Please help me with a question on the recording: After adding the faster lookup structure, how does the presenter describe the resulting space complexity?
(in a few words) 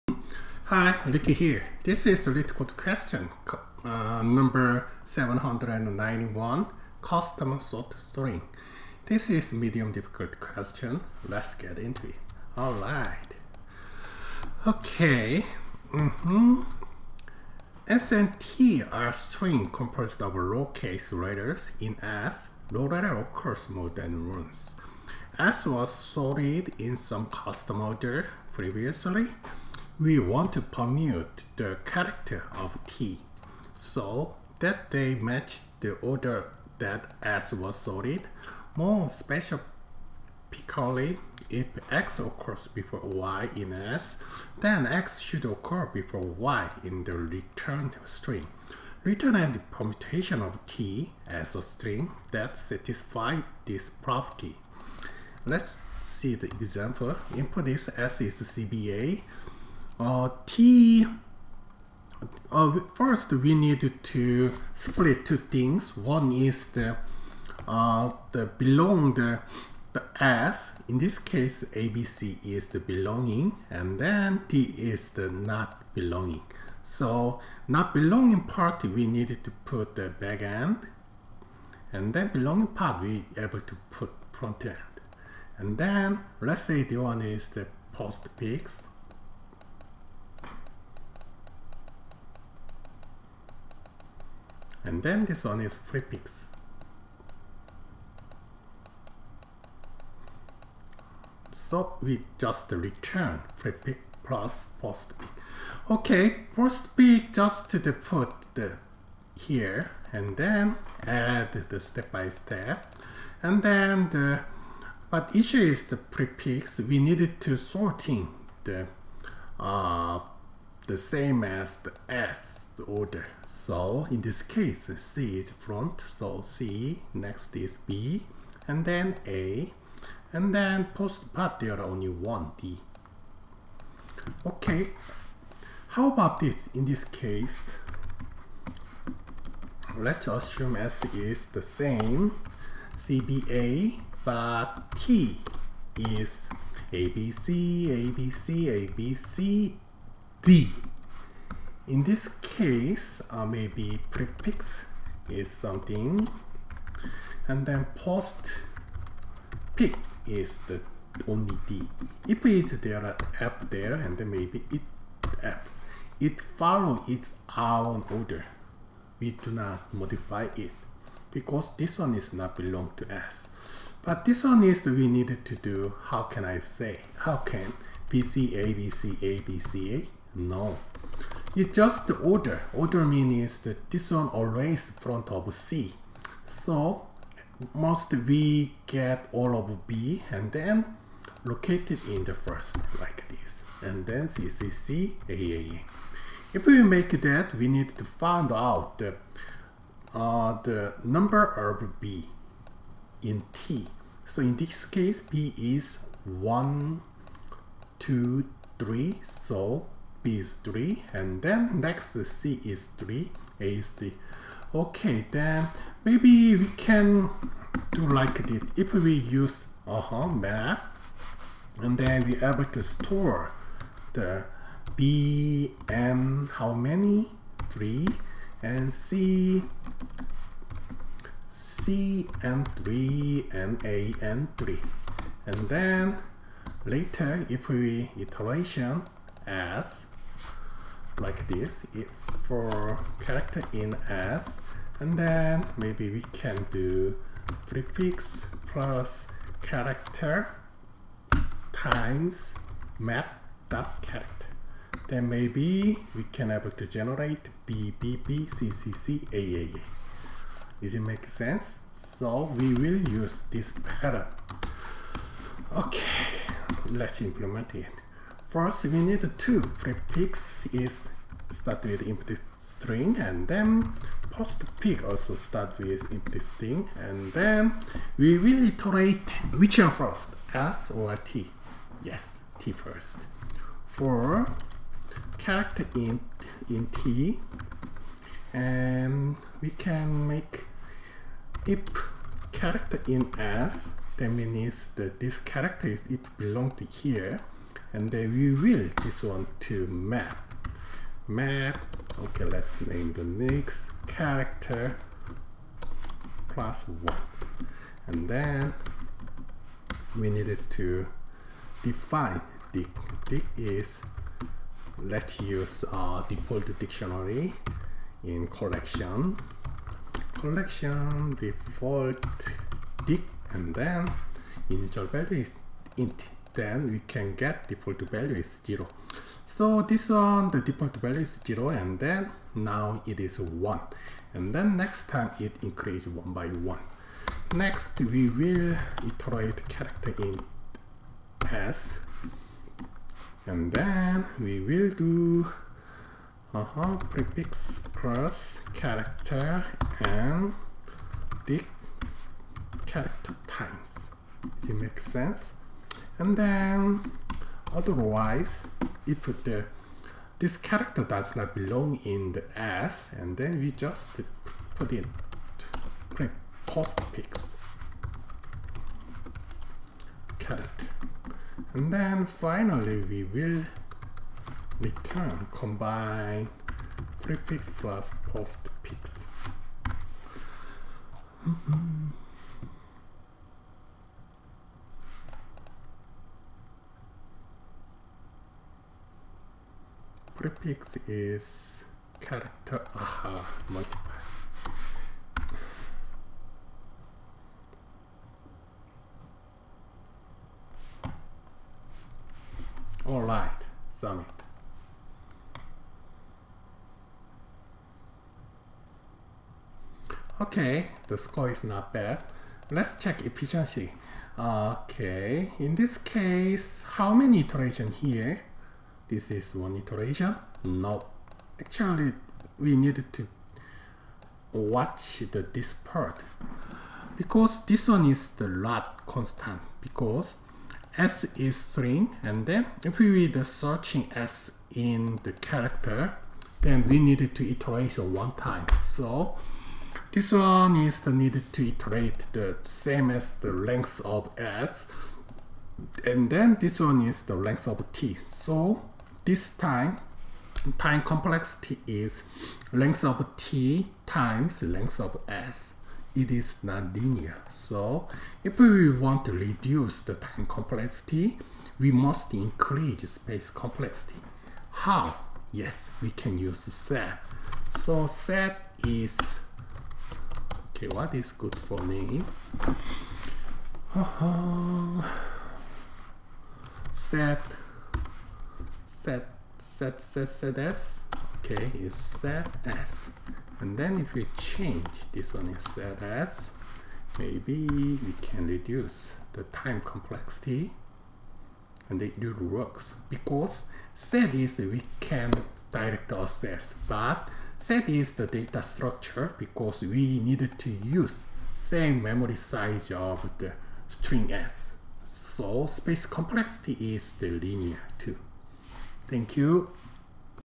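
linear.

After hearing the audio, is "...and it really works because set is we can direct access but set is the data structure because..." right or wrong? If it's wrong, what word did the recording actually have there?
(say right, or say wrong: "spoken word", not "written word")
right.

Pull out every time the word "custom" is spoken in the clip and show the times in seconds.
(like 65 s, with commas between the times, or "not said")
7 s, 27 s.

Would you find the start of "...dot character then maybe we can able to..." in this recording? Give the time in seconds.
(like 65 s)
253 s.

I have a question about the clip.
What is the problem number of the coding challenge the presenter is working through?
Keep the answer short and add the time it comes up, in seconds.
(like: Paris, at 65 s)
791, at 4 s.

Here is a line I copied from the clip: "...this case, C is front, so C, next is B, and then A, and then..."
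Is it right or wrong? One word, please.
right.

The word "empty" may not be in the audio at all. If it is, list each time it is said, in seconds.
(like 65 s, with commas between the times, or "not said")
272 s, 276 s.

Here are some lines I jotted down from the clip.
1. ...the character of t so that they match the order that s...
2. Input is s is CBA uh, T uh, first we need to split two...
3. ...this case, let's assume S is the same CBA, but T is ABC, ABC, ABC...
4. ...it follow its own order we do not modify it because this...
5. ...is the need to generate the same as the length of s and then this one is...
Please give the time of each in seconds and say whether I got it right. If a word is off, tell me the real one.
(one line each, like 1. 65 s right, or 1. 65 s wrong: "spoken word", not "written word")
1. 31 s right
2. 57 s right
3. 136 s right
4. 166 s right
5. 440 s wrong: "iterate", not "generate".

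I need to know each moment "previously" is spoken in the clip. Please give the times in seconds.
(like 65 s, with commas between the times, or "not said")
28 s.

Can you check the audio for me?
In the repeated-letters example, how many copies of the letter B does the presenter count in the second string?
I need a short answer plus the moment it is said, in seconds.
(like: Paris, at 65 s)
3, at 210 s.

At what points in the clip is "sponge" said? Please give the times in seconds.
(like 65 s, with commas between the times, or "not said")
not said.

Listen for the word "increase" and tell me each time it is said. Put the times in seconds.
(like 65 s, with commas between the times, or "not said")
335 s, 462 s.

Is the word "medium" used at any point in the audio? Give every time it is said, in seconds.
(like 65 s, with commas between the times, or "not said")
9 s.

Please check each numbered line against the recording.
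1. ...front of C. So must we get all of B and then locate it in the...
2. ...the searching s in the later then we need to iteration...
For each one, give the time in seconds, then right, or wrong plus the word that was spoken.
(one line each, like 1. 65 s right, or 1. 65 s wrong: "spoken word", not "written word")
1. 184 s right
2. 433 s wrong: "character", not "later".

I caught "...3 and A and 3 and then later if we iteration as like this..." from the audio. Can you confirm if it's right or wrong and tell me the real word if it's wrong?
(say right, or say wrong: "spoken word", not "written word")
right.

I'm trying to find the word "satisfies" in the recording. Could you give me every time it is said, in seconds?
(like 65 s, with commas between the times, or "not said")
52 s.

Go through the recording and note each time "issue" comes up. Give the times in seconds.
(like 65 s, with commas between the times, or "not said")
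115 s.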